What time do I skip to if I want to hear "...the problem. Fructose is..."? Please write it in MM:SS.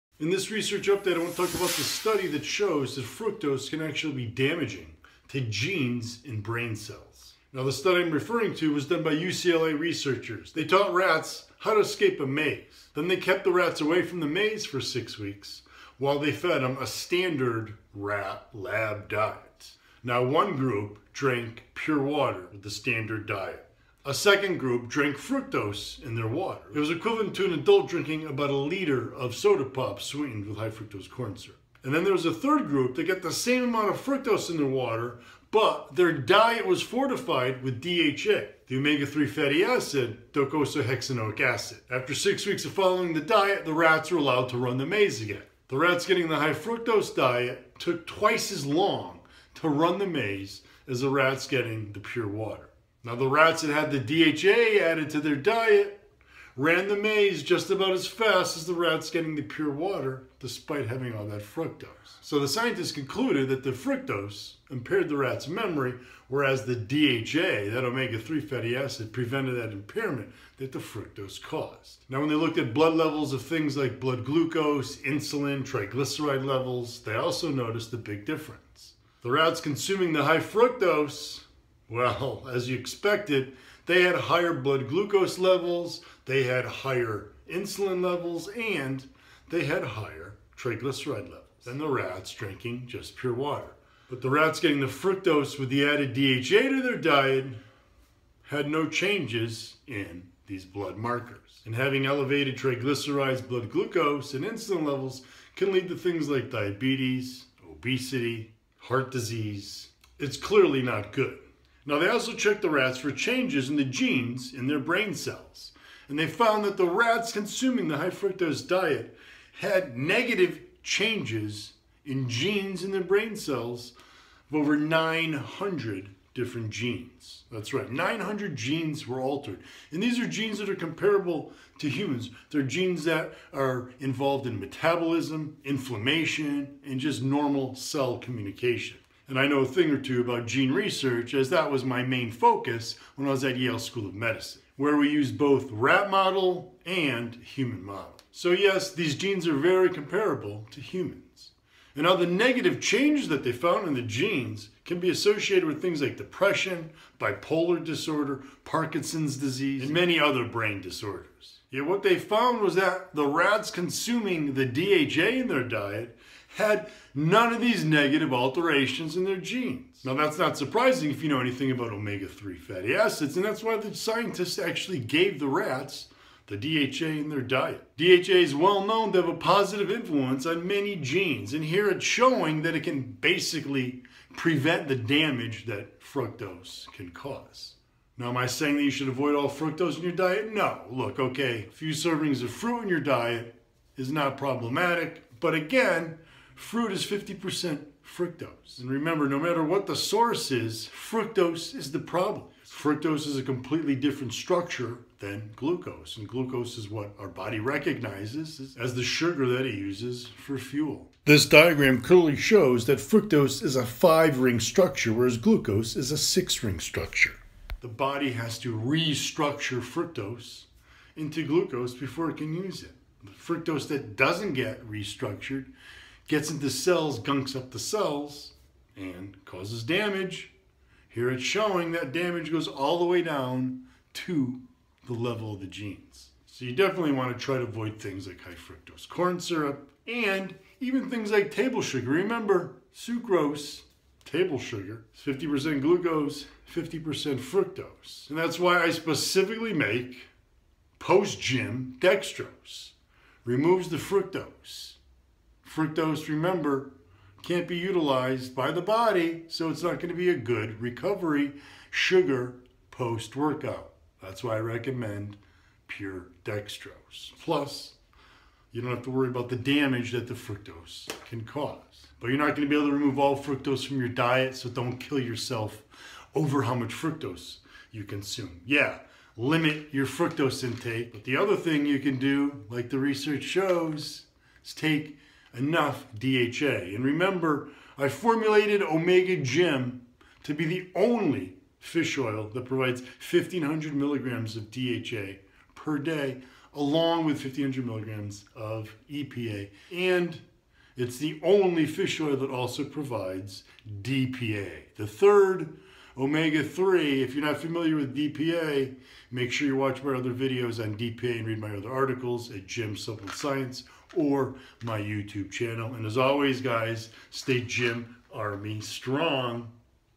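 03:21.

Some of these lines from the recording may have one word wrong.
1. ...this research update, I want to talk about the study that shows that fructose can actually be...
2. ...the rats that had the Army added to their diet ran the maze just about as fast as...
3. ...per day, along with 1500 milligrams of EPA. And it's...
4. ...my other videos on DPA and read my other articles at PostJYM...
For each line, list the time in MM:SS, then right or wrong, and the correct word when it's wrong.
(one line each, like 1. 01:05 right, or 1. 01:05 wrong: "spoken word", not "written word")
1. 00:00 right
2. 00:53 wrong: "DHA", not "Army"
3. 04:55 right
4. 05:10 wrong: "JYM", not "PostJYM".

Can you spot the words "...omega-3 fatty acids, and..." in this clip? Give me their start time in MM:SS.
02:51.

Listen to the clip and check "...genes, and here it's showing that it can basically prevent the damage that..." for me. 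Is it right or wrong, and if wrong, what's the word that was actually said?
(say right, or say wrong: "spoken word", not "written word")
right.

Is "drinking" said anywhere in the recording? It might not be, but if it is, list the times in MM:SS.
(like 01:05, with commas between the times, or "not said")
00:27, 01:32.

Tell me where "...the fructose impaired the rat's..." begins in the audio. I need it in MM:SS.
01:03.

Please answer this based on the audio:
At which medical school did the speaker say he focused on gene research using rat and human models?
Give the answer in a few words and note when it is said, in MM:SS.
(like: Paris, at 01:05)
Yale School of Medicine, at 02:23.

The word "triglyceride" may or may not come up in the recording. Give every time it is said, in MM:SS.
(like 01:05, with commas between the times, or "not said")
01:15, 01:30, 01:42.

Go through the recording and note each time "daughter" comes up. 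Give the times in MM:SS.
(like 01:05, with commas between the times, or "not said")
not said.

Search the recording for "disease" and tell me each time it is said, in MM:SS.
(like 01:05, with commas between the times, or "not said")
01:49, 02:39.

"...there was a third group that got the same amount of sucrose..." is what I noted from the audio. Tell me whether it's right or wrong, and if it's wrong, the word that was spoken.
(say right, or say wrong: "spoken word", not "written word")
wrong: "fructose", not "sucrose".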